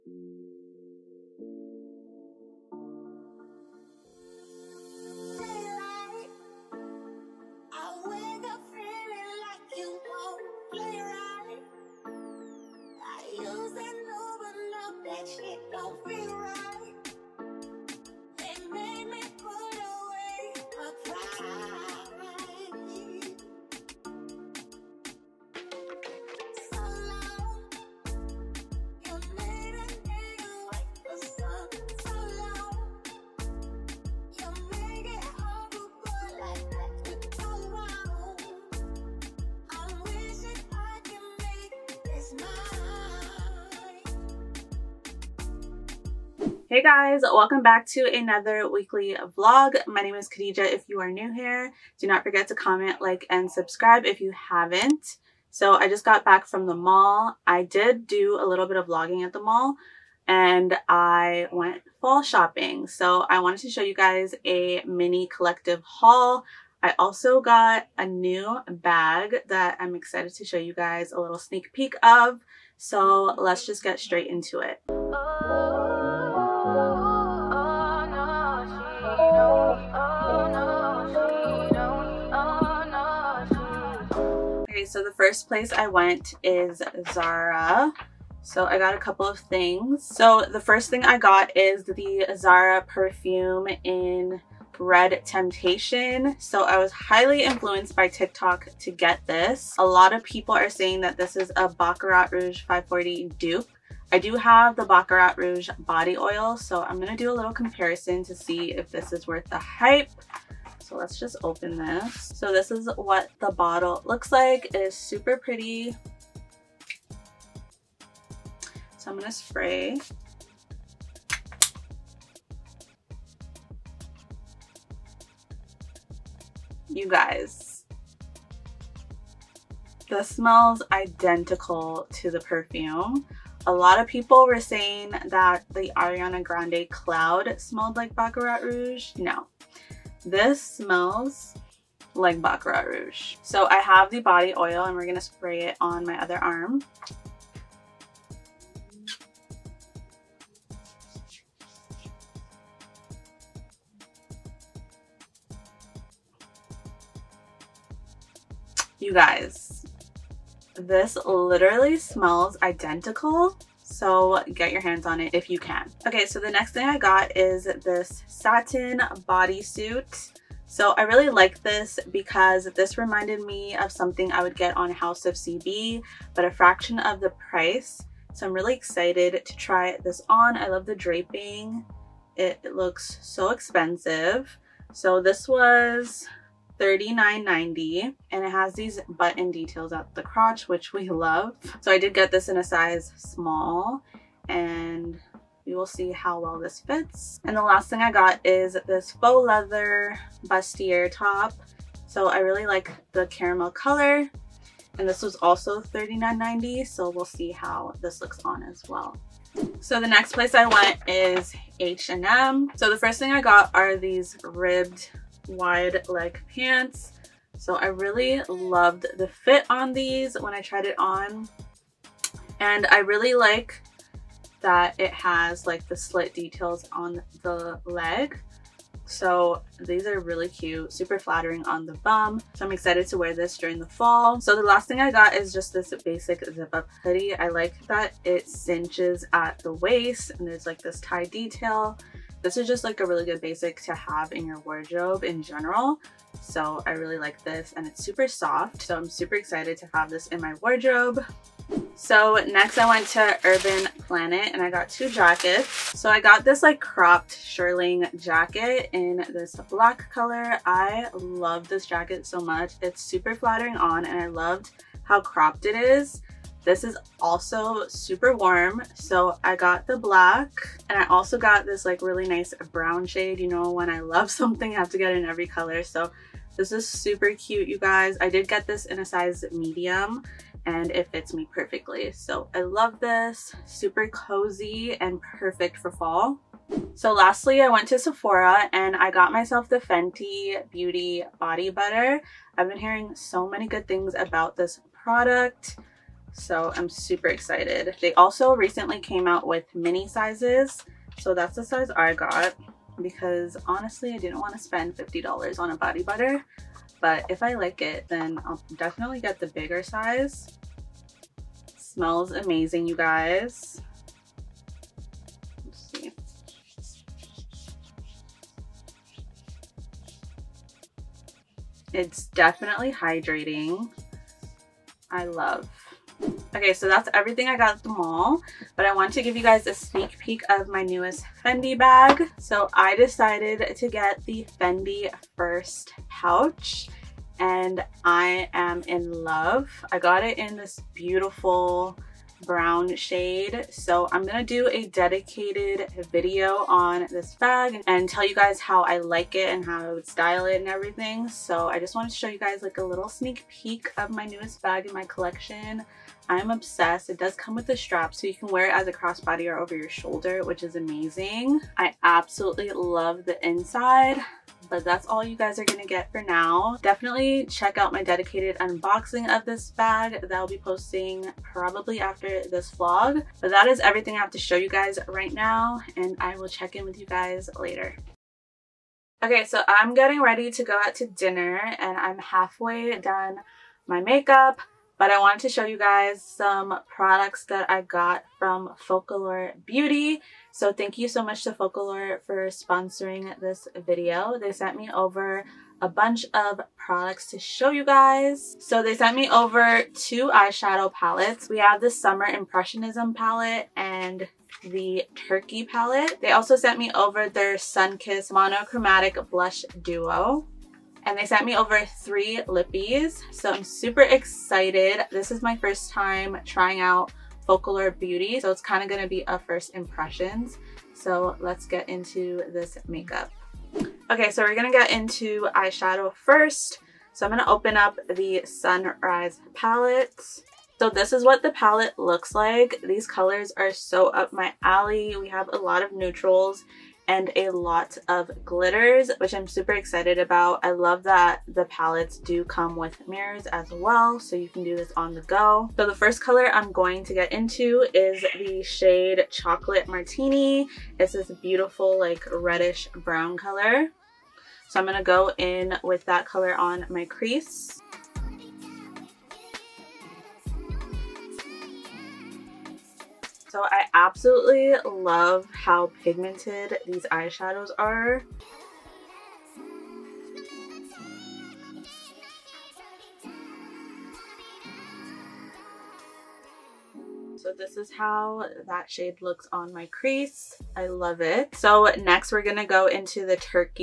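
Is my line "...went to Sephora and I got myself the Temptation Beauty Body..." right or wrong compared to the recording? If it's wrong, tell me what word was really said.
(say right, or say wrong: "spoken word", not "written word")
wrong: "Fenty", not "Temptation".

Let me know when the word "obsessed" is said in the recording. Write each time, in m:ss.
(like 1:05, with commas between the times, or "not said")
5:56.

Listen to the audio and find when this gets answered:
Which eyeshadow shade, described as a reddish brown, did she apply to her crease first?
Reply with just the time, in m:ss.
7:29.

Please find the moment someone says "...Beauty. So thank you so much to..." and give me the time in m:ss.
6:29.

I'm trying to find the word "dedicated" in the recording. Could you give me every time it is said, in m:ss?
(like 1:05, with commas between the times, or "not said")
5:44, 6:08.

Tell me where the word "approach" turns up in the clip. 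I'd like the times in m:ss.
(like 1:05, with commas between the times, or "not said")
not said.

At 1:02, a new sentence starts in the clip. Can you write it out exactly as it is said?
So I wanted to show you guys a mini collective haul.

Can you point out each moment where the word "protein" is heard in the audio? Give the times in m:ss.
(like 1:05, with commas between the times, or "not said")
not said.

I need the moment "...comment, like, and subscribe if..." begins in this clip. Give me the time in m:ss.
0:52.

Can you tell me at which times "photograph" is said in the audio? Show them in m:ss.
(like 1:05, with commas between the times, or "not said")
not said.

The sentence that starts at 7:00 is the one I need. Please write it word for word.
So let's get into this makeup.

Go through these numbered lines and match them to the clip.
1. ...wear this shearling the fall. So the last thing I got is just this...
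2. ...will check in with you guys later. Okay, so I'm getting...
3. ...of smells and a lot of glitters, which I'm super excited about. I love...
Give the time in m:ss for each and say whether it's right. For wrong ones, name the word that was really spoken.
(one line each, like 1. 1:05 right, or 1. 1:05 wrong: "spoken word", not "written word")
1. 3:53 wrong: "during", not "shearling"
2. 6:16 right
3. 7:15 wrong: "neutrals", not "smells".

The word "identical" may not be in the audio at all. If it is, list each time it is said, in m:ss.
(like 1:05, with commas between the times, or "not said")
2:10, 2:42.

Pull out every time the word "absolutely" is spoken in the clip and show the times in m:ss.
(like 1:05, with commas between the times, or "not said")
6:02, 7:43.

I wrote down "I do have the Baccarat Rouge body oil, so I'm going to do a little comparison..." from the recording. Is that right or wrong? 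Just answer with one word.
right.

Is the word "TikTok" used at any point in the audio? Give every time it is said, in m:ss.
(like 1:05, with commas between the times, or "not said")
1:38.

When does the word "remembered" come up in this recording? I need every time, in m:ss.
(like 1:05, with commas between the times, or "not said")
not said.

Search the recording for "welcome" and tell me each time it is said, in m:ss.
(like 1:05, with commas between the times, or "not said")
0:47.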